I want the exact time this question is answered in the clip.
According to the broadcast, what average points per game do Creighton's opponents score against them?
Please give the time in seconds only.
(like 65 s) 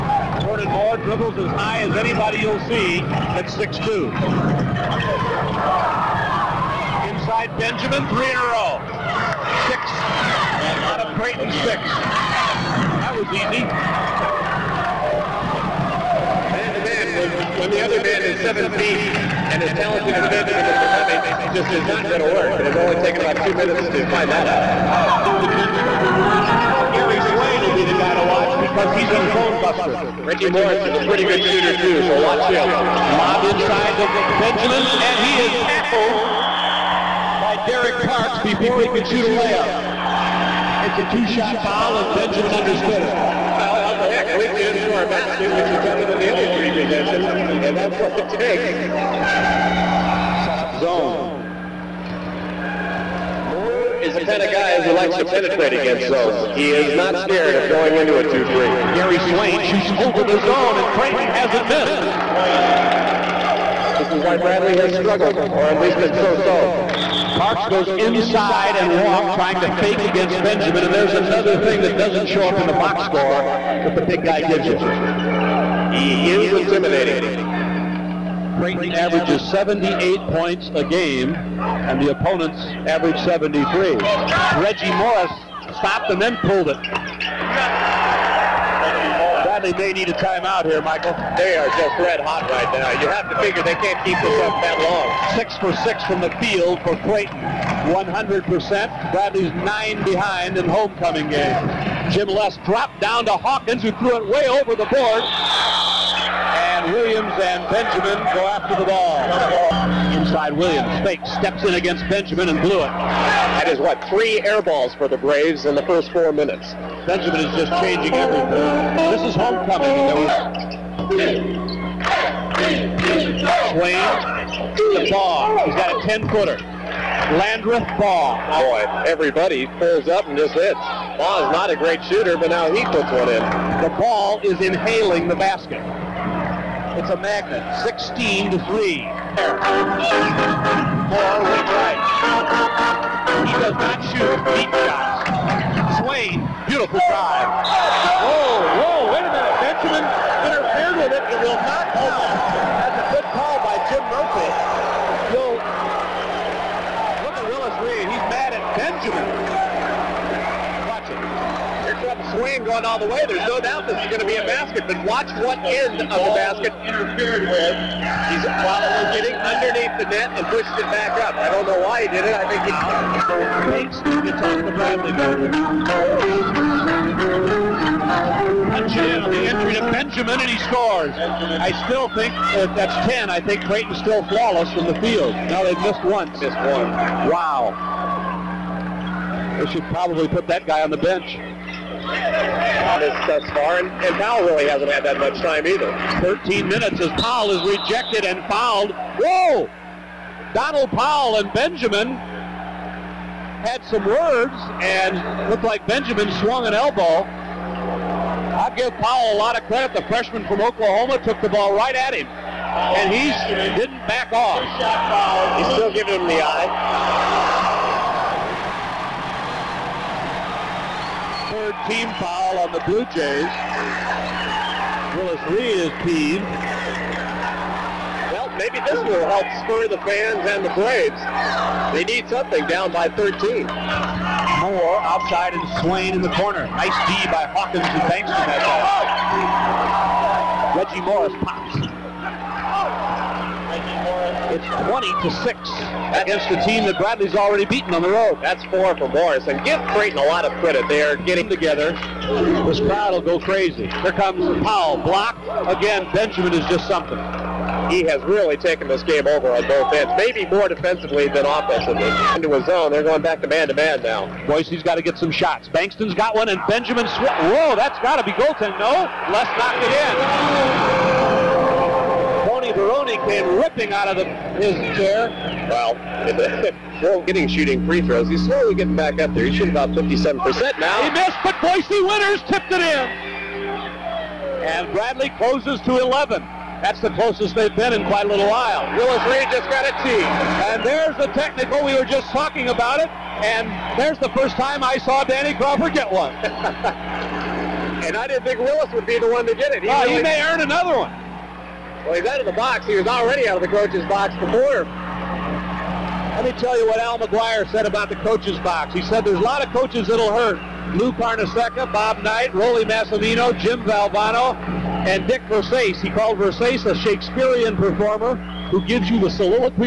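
82 s.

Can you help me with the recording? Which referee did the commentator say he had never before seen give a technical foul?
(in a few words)
Danny Crawford.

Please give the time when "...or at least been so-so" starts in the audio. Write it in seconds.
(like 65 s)
65 s.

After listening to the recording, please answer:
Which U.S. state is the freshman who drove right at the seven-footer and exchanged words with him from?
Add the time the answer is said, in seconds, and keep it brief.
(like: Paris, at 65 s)
Oklahoma, at 210 s.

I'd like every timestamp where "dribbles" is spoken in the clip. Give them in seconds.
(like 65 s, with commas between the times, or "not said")
0 s.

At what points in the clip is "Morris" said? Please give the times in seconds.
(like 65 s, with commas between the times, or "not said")
30 s, 84 s, 240 s, 249 s.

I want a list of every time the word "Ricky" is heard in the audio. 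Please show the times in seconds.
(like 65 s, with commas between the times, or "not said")
30 s.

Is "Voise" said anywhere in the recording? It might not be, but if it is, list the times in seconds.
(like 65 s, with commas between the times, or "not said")
264 s, 281 s.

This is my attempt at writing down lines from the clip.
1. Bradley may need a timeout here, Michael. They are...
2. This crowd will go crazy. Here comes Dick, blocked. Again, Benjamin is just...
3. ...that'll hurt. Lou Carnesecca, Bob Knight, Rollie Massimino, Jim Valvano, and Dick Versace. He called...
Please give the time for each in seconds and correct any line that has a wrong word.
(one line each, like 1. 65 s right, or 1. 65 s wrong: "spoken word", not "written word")
1. 89 s right
2. 252 s wrong: "Powell", not "Dick"
3. 310 s right.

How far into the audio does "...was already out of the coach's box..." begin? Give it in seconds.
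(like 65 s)
302 s.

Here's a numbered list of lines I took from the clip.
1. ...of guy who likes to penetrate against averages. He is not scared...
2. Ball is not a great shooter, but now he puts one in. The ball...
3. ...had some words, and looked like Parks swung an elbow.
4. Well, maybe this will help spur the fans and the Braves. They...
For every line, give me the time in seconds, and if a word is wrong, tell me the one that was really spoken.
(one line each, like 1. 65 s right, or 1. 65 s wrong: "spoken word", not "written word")
1. 54 s wrong: "zones", not "averages"
2. 130 s right
3. 203 s wrong: "Benjamin", not "Parks"
4. 228 s right.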